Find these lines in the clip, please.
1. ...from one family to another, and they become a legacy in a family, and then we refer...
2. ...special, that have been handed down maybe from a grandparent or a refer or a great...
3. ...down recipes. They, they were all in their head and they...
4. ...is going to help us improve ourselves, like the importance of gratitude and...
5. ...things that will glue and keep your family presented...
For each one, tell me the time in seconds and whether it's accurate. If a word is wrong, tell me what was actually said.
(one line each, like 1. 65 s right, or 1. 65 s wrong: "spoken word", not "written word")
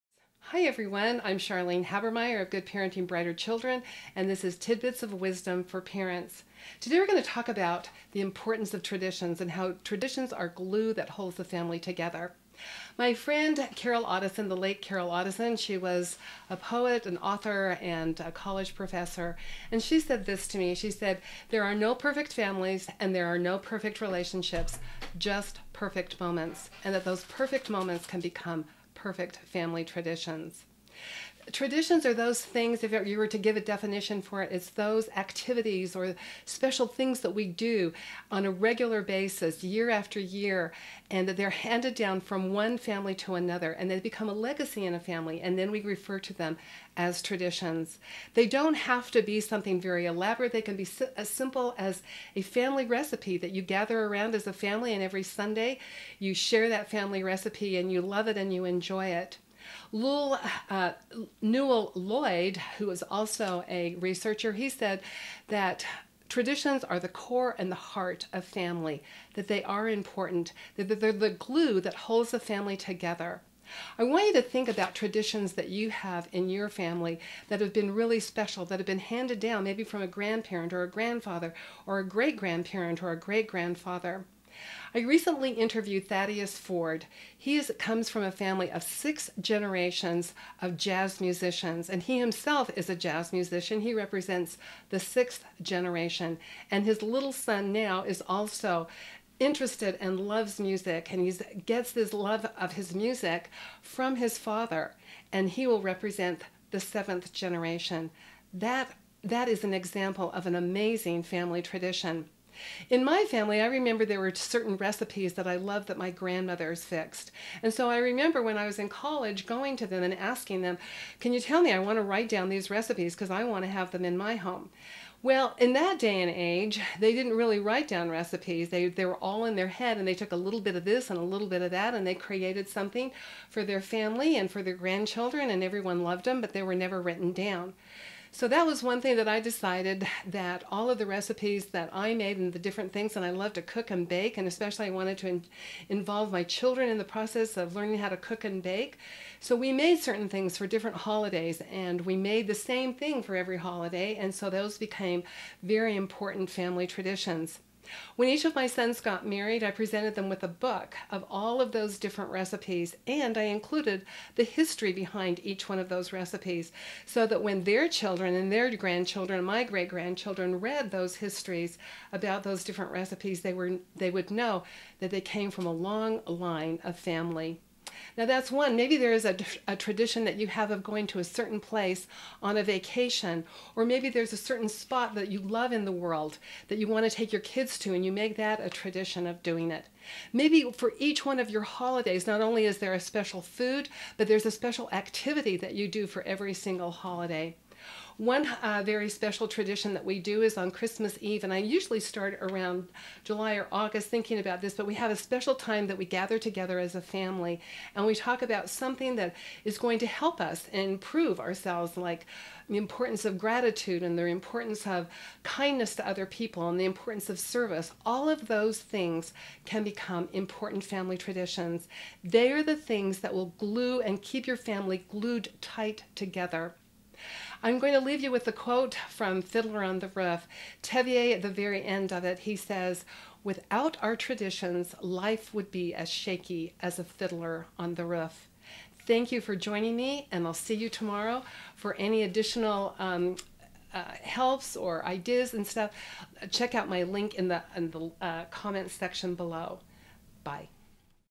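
1. 42 s right
2. 78 s wrong: "grandfather", not "refer"
3. 127 s right
4. 209 s right
5. 222 s wrong: "glued", not "presented".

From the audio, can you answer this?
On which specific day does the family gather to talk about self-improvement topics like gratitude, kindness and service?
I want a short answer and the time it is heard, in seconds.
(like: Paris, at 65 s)
Christmas Eve, at 200 s.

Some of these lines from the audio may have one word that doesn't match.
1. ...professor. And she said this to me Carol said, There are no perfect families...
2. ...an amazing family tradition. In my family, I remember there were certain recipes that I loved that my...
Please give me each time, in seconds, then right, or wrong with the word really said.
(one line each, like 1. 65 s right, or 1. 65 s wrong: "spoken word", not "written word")
1. 18 s wrong: "She", not "Carol"
2. 110 s right.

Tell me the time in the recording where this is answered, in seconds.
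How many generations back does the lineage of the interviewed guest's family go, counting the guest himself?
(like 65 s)
88 s.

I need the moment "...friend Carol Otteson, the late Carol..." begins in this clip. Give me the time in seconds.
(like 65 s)
13 s.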